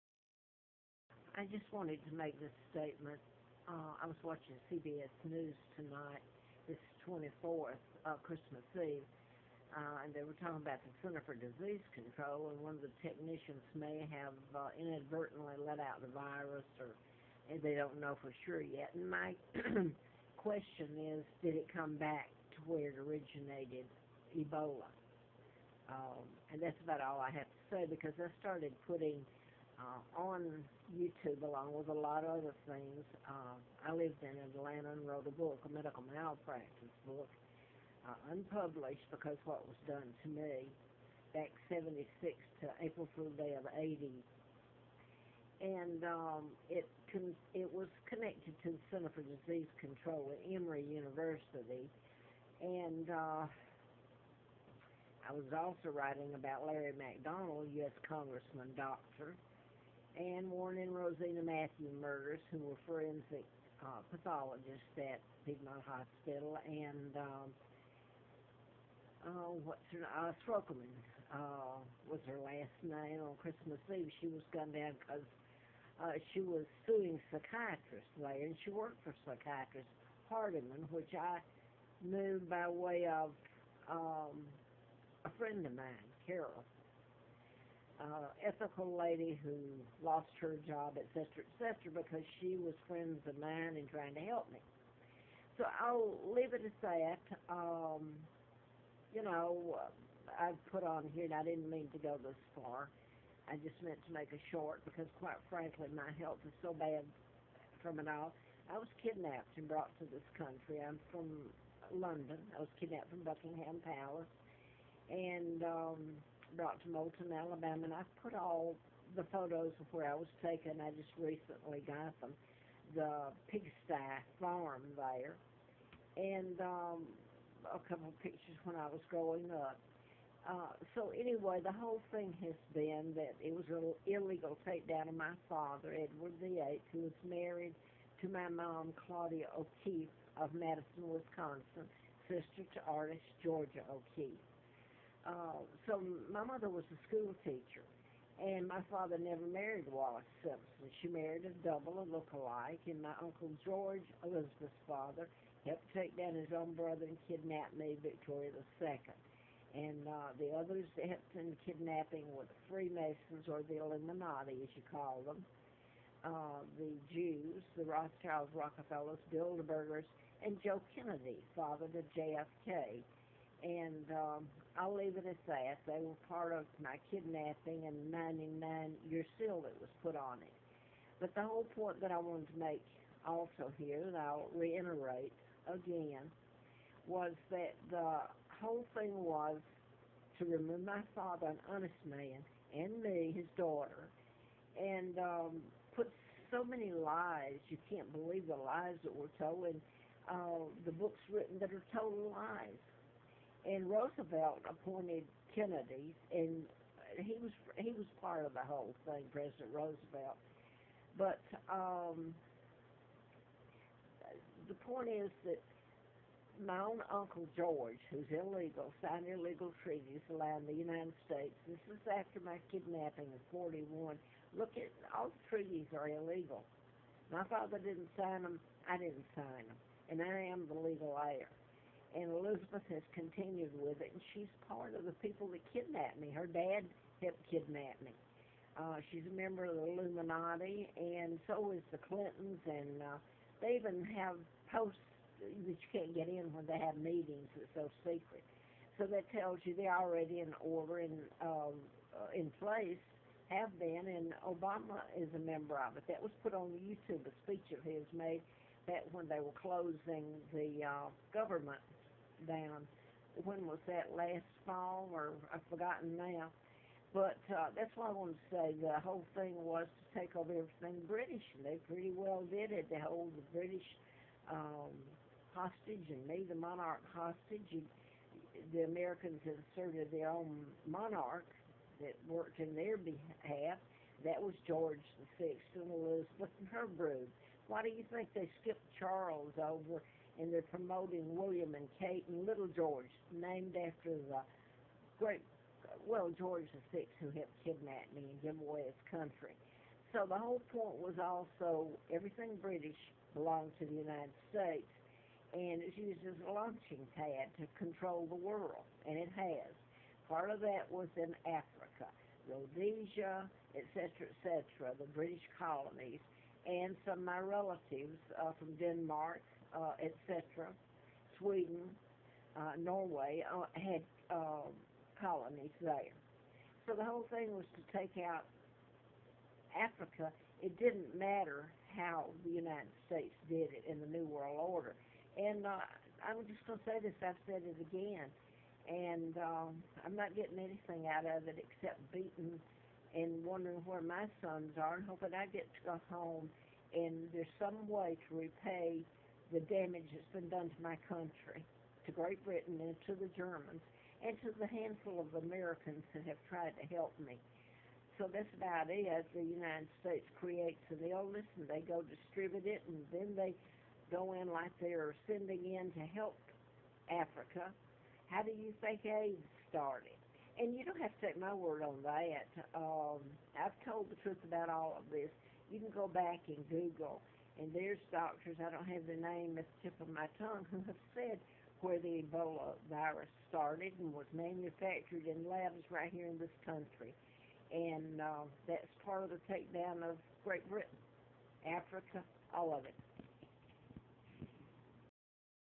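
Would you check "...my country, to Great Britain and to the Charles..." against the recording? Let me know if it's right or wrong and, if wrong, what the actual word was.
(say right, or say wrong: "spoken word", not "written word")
wrong: "Germans", not "Charles".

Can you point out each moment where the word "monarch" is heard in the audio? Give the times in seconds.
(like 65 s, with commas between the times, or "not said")
276 s, 280 s.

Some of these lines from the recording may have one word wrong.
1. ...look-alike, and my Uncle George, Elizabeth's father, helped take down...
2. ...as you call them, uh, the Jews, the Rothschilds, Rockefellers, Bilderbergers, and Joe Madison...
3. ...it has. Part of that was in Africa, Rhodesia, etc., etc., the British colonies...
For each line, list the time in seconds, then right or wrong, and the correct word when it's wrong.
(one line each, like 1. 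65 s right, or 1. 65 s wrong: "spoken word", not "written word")
1. 152 s right
2. 164 s wrong: "Kennedy", not "Madison"
3. 309 s right.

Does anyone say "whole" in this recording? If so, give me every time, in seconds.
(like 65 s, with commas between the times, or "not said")
131 s, 181 s, 188 s, 208 s, 269 s, 300 s, 327 s.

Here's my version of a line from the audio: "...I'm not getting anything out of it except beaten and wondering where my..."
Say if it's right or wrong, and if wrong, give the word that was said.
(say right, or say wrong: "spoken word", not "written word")
right.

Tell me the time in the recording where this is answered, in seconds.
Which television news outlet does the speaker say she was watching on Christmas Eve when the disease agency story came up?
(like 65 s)
4 s.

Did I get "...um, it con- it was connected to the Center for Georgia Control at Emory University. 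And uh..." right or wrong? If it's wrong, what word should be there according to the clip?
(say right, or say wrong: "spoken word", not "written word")
wrong: "Disease", not "Georgia".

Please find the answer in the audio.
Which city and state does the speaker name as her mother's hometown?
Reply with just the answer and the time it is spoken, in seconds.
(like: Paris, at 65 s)
Madison, Wisconsin, at 140 s.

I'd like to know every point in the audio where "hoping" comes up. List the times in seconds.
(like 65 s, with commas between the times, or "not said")
345 s.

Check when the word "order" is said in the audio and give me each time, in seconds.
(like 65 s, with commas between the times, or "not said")
250 s, 334 s.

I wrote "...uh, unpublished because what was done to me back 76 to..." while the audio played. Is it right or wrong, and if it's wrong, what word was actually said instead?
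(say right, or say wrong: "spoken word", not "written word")
right.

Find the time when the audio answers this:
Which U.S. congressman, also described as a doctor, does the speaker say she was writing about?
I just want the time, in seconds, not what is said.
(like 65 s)
56 s.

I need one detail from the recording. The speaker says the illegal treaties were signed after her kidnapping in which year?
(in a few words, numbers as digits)
1941.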